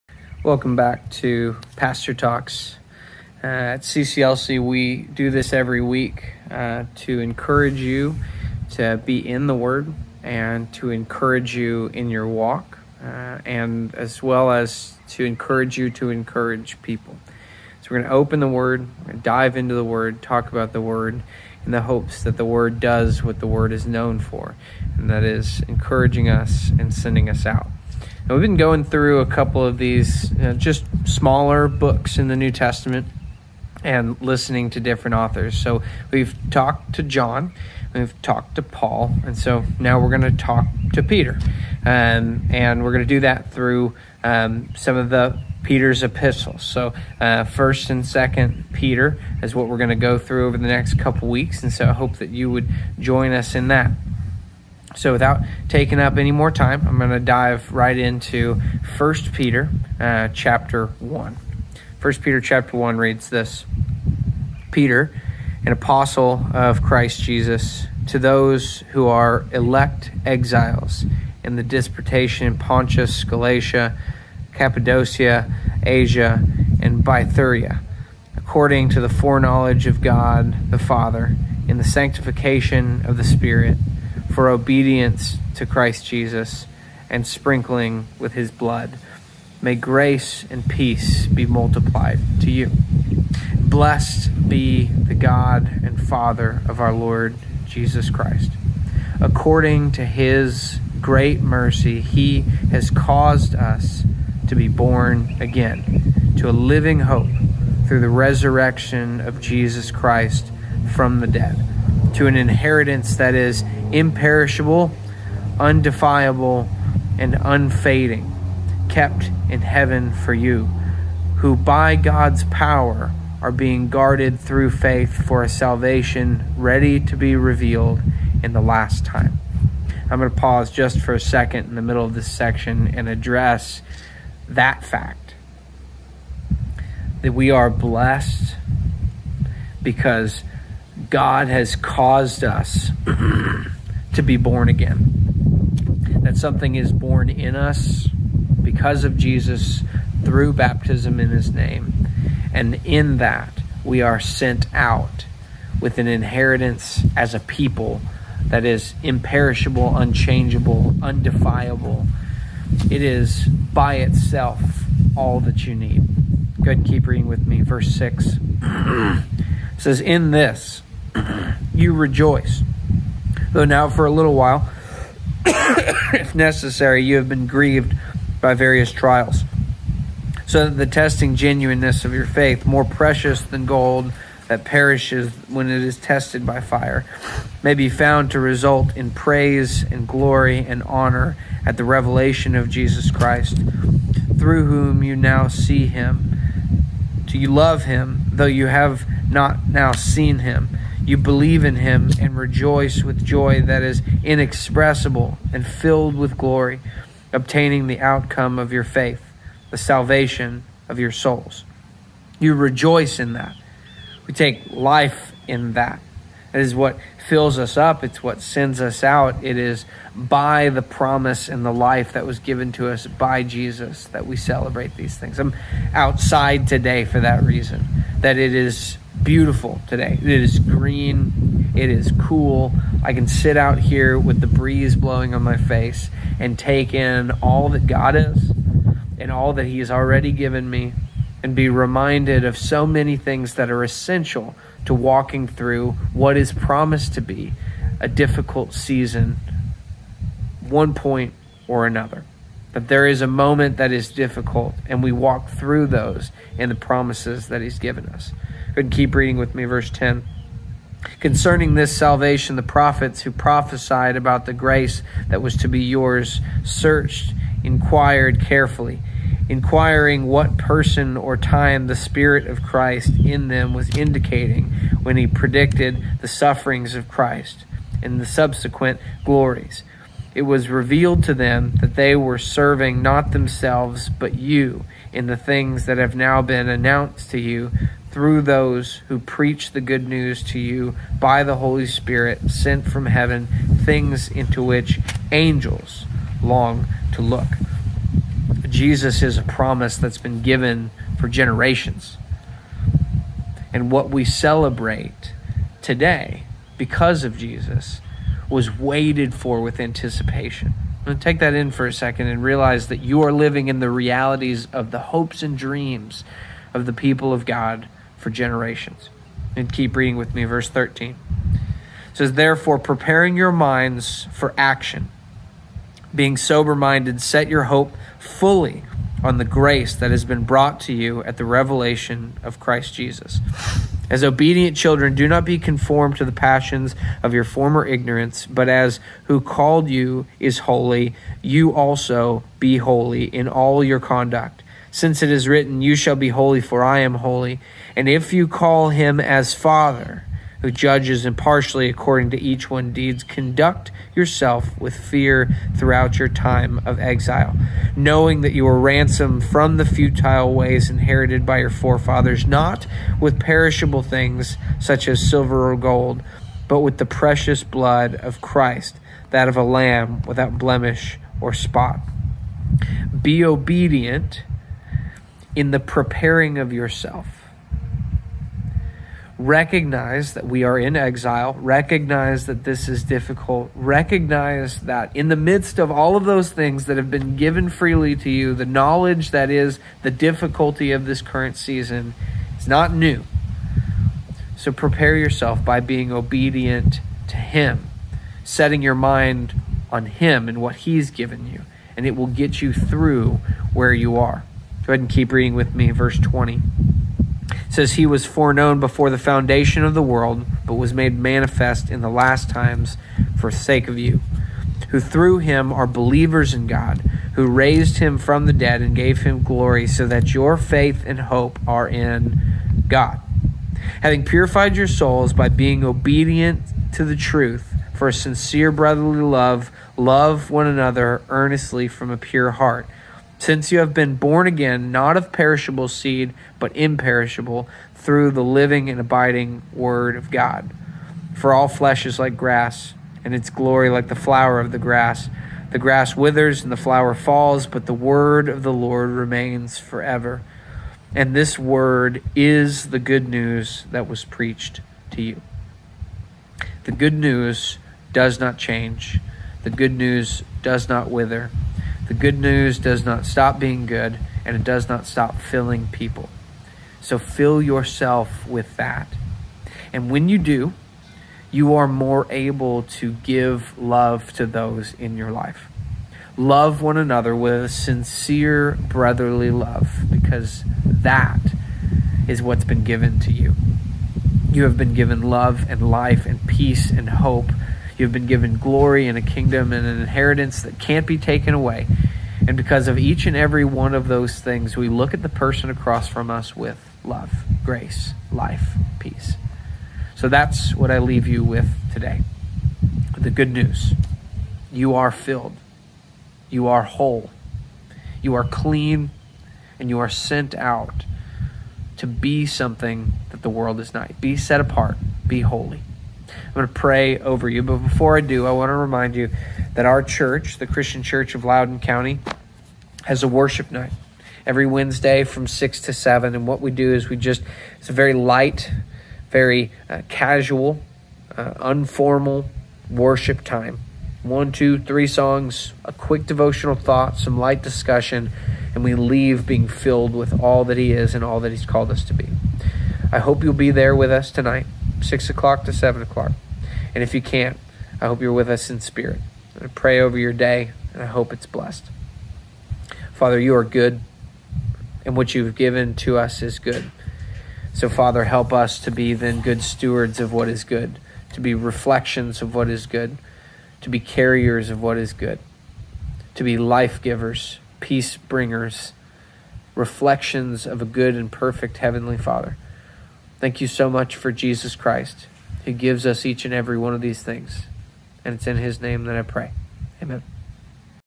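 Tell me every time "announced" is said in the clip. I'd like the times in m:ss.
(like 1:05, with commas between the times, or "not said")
4:46.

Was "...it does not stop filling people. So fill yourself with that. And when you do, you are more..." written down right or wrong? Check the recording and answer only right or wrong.
right.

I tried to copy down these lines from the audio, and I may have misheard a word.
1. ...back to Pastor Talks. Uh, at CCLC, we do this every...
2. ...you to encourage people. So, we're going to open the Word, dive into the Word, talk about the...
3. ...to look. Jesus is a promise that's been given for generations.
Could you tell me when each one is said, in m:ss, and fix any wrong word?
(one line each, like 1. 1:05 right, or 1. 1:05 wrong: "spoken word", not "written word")
1. 0:00 right
2. 0:15 right
3. 4:57 right.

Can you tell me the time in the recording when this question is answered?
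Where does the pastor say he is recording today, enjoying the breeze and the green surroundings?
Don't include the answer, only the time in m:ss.
3:45.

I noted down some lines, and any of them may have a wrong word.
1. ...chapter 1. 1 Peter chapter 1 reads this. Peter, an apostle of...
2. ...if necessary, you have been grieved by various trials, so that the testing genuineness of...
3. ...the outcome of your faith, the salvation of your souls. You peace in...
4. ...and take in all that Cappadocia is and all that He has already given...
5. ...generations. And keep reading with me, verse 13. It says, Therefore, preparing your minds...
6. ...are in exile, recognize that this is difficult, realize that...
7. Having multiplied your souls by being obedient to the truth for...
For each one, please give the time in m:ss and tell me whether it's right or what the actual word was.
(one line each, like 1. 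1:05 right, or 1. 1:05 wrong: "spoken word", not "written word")
1. 1:00 right
2. 2:55 right
3. 3:27 wrong: "rejoice", not "peace"
4. 3:56 wrong: "God", not "Cappadocia"
5. 5:18 right
6. 6:20 wrong: "recognize", not "realize"
7. 7:04 wrong: "purified", not "multiplied".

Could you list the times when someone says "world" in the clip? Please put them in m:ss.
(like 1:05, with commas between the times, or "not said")
6:50, 8:33.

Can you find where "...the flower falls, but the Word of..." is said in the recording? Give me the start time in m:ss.
7:26.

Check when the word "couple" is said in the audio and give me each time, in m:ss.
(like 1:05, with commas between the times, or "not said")
0:29, 0:50.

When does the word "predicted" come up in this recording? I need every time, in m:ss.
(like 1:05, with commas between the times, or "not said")
4:35.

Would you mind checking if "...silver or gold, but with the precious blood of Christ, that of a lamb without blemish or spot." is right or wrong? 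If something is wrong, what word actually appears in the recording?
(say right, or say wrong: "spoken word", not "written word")
right.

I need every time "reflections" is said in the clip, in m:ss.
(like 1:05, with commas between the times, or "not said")
9:21, 9:29.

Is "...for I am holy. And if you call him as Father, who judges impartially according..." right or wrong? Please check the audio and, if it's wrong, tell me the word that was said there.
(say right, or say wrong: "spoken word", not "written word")
right.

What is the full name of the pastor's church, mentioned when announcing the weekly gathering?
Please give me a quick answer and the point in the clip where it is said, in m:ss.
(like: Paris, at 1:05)
Christian Church of Loudon County, at 8:40.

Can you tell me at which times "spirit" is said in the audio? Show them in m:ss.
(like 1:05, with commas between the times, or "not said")
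1:23, 4:31, 4:51, 9:08.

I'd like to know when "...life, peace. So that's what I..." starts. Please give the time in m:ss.
8:18.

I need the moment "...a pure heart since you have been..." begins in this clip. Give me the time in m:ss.
7:12.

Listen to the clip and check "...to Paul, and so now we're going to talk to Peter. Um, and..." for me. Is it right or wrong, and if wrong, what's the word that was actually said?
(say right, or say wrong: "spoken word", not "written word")
right.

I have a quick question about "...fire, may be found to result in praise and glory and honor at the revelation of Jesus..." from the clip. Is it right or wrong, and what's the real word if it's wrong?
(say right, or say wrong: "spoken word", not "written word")
right.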